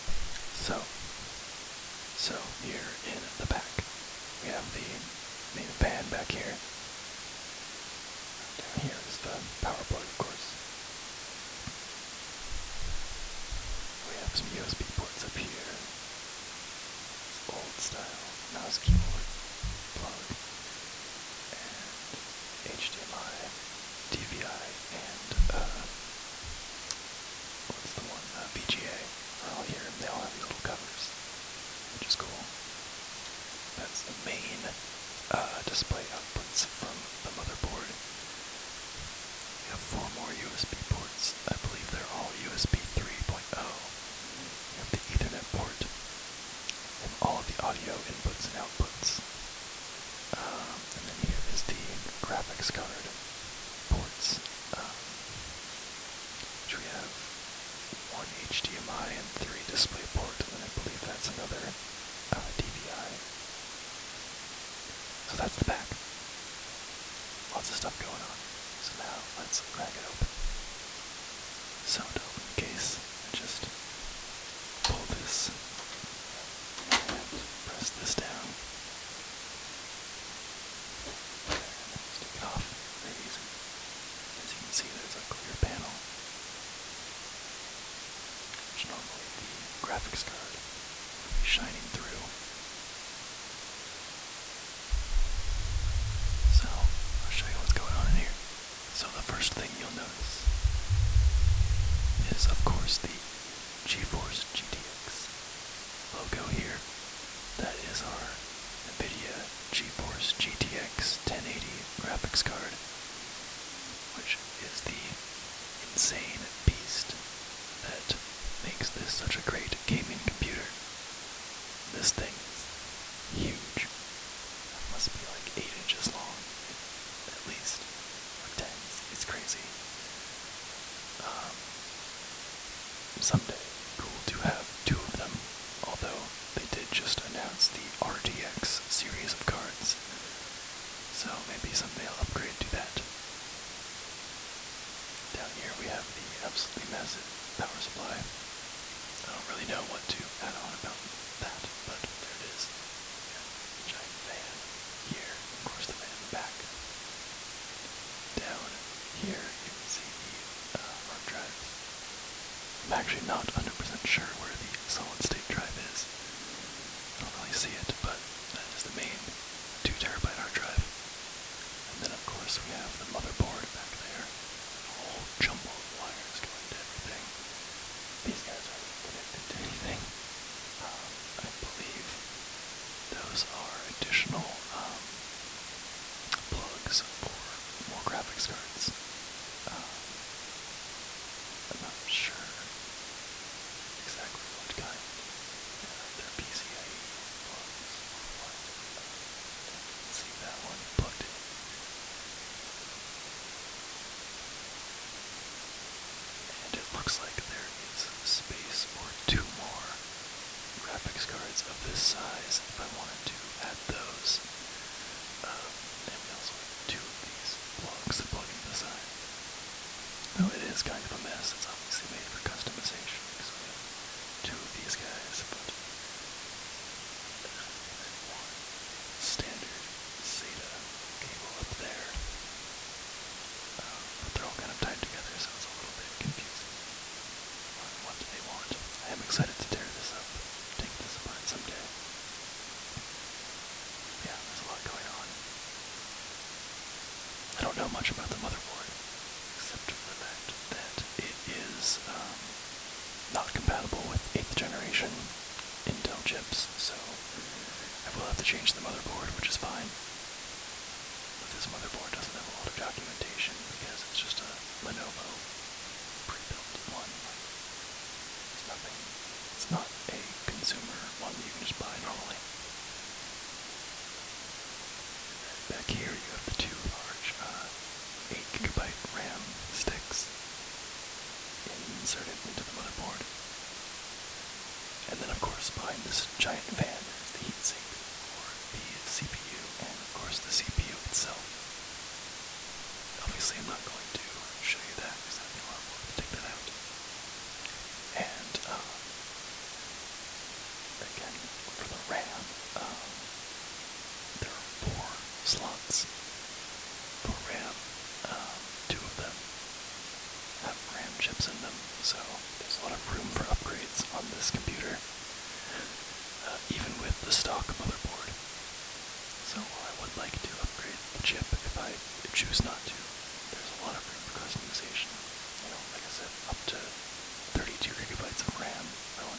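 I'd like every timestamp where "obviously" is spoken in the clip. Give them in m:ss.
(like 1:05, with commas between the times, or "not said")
3:41, 4:53.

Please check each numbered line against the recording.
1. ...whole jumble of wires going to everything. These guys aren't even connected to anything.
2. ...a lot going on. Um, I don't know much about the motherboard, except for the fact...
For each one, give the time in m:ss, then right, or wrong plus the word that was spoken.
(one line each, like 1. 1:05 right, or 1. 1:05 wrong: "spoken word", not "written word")
1. 2:54 right
2. 4:04 right.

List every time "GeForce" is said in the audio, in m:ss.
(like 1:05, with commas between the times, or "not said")
1:43, 1:49.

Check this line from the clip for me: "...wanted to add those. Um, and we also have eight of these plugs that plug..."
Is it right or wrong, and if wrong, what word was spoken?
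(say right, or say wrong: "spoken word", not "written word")
wrong: "two", not "eight".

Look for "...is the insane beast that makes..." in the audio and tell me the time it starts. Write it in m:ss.
1:54.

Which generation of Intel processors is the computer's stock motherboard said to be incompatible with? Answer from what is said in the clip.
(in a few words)
8th generation.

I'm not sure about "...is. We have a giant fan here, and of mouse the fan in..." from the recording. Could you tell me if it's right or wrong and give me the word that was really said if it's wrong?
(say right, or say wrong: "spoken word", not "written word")
wrong: "course", not "mouse".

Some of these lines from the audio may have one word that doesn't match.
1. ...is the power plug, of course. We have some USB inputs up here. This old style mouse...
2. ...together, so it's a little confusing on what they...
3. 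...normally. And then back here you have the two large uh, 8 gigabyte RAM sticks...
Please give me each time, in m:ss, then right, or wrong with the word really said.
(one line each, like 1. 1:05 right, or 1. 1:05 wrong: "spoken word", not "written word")
1. 0:09 wrong: "ports", not "inputs"
2. 3:55 right
3. 4:32 right.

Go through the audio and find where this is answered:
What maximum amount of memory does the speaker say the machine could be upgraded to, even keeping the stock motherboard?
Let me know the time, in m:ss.
5:27.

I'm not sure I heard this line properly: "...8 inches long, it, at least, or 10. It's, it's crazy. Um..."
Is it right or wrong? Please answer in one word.
right.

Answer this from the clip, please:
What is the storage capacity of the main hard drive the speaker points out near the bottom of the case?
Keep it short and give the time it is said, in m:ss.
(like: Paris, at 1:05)
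2 terabytes, at 2:49.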